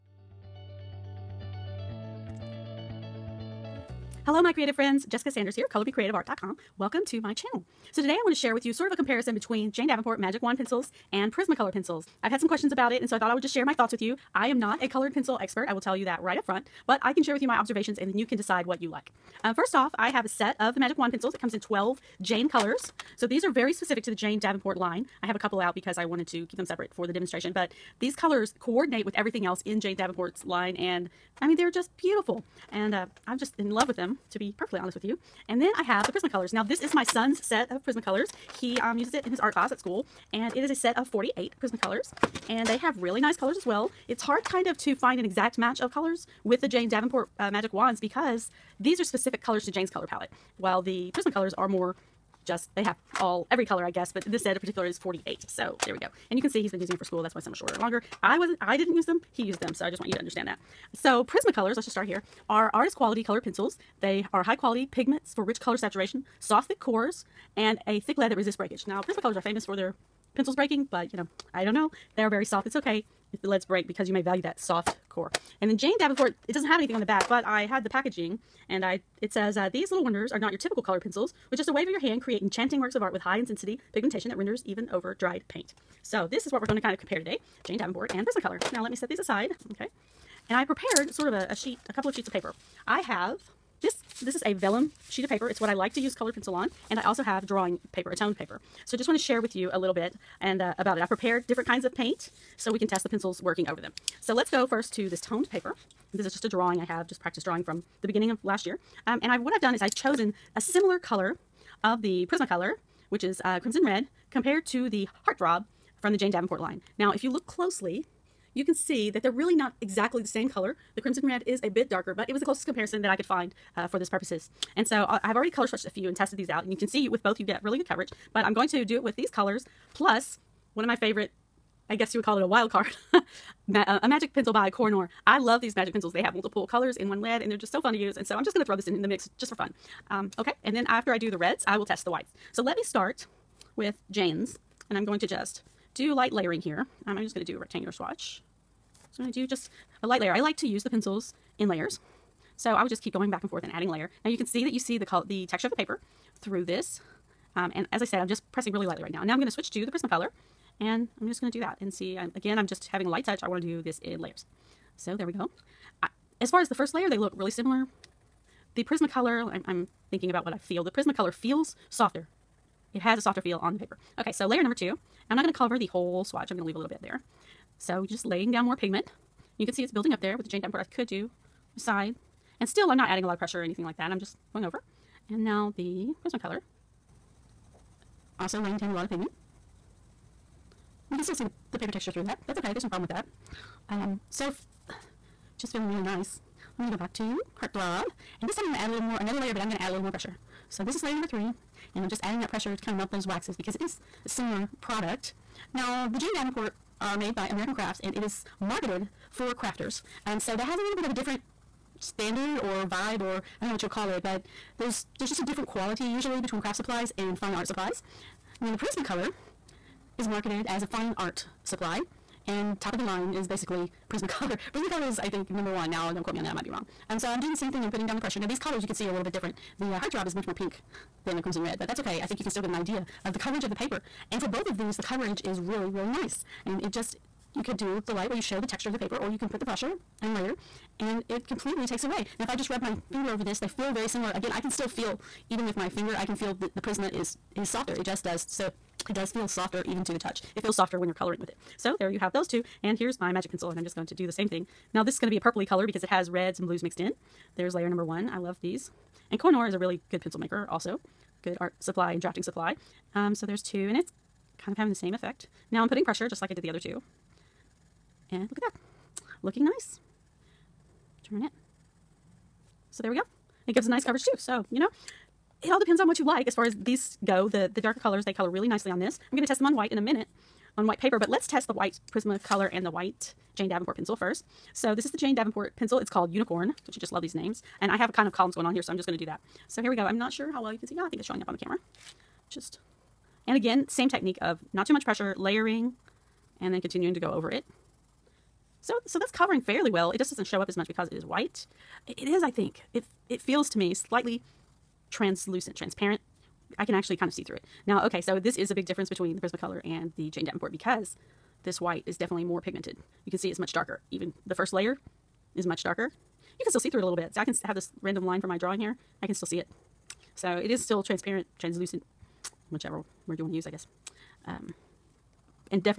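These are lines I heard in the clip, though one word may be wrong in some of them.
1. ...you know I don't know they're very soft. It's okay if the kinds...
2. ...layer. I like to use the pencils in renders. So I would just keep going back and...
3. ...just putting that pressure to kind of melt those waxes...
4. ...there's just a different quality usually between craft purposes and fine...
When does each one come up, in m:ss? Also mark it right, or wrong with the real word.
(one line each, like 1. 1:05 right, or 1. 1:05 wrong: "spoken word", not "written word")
1. 1:11 wrong: "leads", not "kinds"
2. 2:30 wrong: "layers", not "renders"
3. 3:22 wrong: "adding", not "putting"
4. 3:35 wrong: "supplies", not "purposes".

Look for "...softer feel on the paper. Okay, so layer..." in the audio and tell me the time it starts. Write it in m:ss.
2:53.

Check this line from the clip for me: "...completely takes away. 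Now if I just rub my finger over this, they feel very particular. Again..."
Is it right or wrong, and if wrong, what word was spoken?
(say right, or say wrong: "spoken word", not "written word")
wrong: "similar", not "particular".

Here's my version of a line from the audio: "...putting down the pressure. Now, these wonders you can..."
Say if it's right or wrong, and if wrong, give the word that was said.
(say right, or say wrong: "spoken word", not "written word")
wrong: "colors", not "wonders".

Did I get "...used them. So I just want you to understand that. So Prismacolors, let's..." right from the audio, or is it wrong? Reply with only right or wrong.
right.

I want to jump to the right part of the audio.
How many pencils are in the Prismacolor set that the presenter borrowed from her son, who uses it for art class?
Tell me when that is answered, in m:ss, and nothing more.
0:40.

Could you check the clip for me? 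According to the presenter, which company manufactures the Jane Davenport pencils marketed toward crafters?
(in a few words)
American Crafts.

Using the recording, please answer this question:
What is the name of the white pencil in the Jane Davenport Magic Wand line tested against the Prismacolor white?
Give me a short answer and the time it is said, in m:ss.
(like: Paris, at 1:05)
Unicorn, at 4:46.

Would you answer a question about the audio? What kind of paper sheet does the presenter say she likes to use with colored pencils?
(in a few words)
Vellum.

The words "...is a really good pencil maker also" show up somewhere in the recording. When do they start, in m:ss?
4:19.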